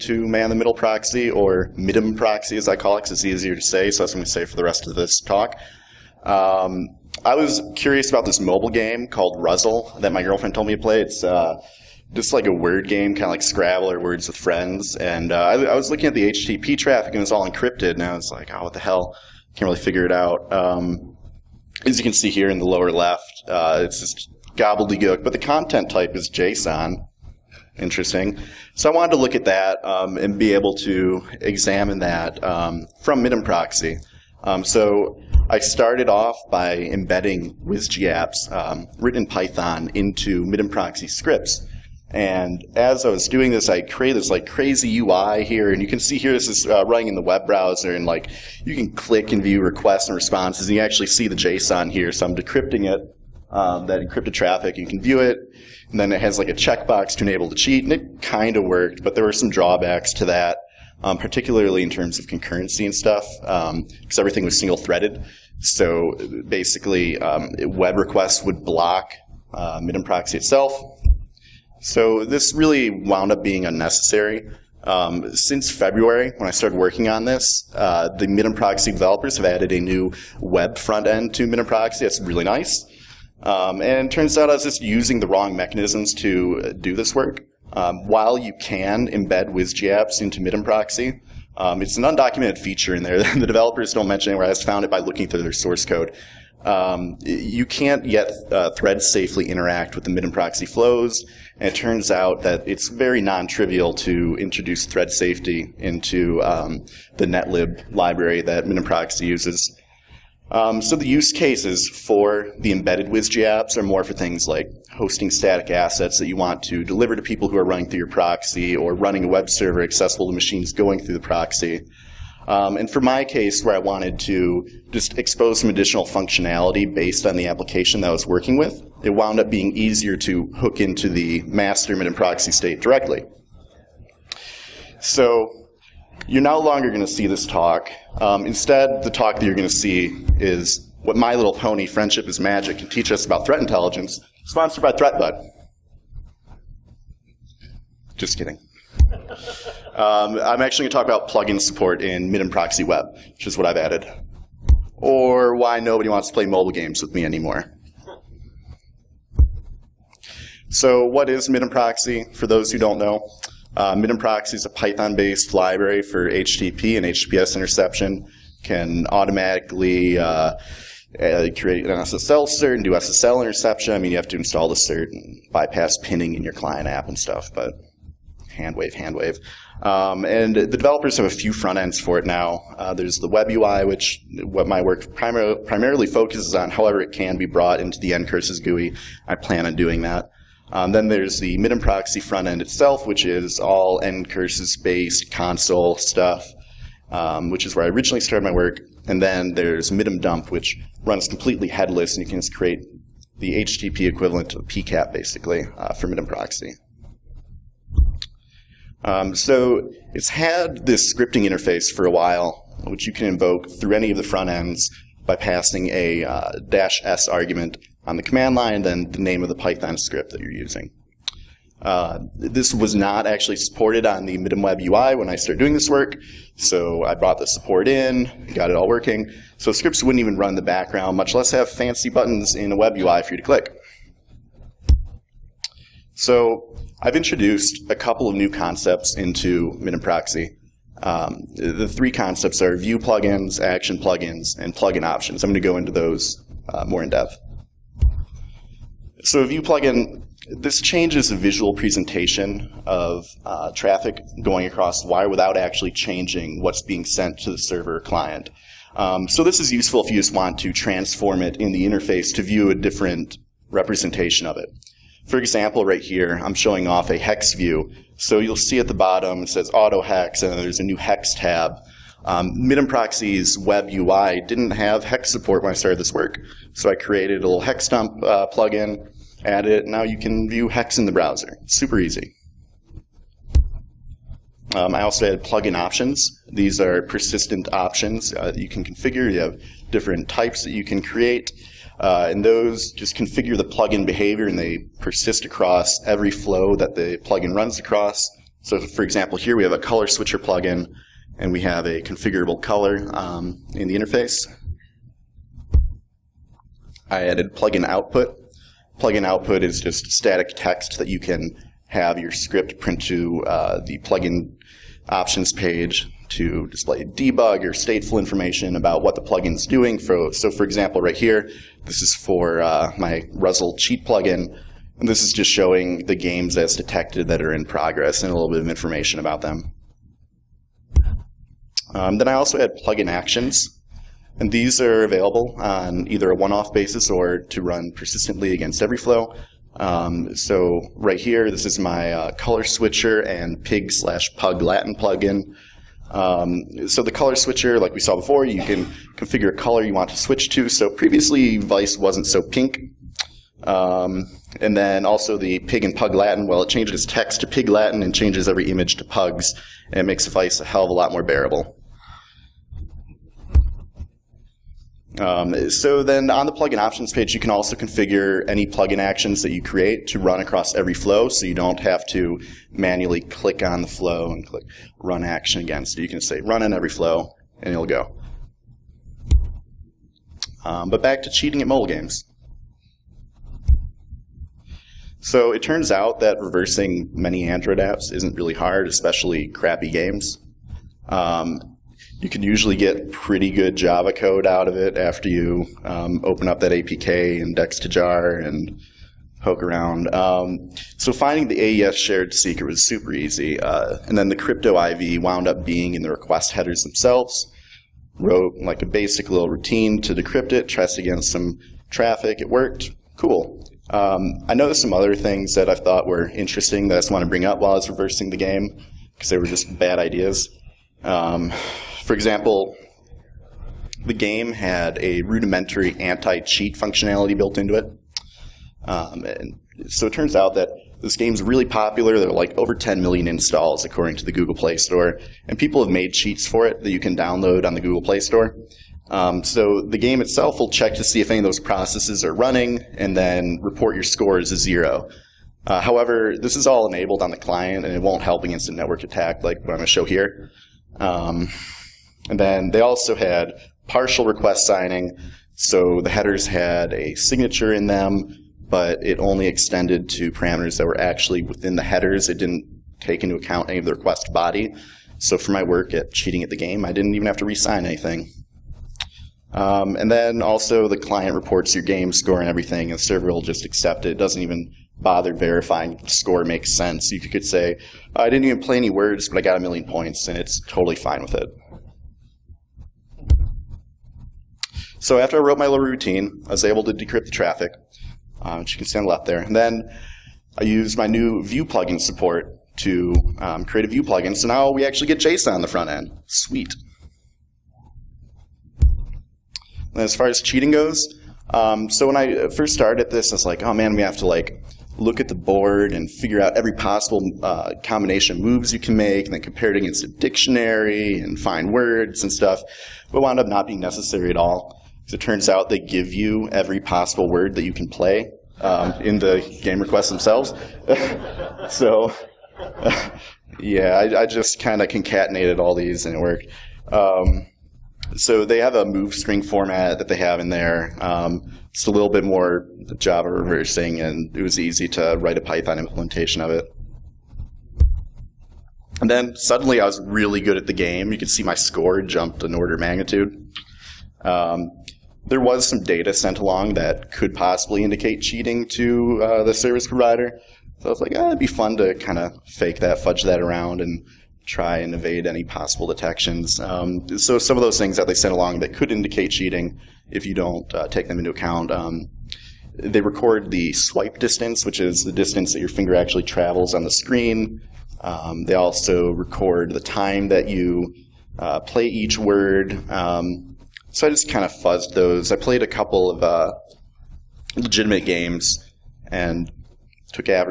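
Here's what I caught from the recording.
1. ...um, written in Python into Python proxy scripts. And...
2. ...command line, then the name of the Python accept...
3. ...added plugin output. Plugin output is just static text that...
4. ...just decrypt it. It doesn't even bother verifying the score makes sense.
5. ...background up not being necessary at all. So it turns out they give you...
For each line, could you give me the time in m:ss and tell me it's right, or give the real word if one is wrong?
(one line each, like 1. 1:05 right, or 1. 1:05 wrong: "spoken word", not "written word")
1. 0:38 wrong: "MITM", not "Python"
2. 3:38 wrong: "script", not "accept"
3. 5:07 right
4. 7:53 wrong: "accept", not "decrypt"
5. 8:33 wrong: "wound", not "background".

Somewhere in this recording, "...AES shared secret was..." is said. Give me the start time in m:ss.
6:41.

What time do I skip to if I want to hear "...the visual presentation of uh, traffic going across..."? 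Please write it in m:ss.
4:11.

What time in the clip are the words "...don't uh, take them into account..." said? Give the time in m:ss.
9:20.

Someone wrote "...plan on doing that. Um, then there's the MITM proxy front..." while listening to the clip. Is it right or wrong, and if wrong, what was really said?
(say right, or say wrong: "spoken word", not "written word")
right.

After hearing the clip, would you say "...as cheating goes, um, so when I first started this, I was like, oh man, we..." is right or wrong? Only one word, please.
right.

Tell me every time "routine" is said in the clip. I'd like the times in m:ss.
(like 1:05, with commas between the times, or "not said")
6:49, 8:05.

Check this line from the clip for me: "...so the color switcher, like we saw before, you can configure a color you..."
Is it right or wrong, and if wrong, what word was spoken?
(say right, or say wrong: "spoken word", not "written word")
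right.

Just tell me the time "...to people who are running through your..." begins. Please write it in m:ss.
1:57.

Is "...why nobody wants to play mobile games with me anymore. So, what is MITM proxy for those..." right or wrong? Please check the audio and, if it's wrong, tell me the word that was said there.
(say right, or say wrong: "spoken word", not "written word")
right.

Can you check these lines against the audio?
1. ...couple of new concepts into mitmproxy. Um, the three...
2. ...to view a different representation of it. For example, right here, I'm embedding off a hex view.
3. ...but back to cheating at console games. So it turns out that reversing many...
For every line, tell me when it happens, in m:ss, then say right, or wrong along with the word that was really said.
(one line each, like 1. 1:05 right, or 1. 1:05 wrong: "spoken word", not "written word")
1. 3:57 right
2. 4:22 wrong: "showing", not "embedding"
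3. 6:20 wrong: "mobile", not "console".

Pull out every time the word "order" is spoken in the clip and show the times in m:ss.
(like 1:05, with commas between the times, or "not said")
9:02.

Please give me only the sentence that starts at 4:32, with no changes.
Um, MITM Proxy's web UI didn't have hex support when I started this work.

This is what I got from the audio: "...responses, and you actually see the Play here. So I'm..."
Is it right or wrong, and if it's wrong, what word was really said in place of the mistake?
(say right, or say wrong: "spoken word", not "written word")
wrong: "JSON", not "Play".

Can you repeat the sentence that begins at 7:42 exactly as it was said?
It didn't take into account any of the request body.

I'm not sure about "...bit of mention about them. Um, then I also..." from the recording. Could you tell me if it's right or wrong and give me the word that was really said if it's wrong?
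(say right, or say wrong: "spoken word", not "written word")
wrong: "information", not "mention".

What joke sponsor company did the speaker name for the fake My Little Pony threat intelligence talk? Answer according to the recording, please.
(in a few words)
ThreatBud.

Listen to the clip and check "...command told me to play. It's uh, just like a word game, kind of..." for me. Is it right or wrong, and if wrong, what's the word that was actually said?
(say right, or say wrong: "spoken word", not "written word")
wrong: "girlfriend", not "command".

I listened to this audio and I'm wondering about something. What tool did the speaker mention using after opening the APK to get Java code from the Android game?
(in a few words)
dex2jar.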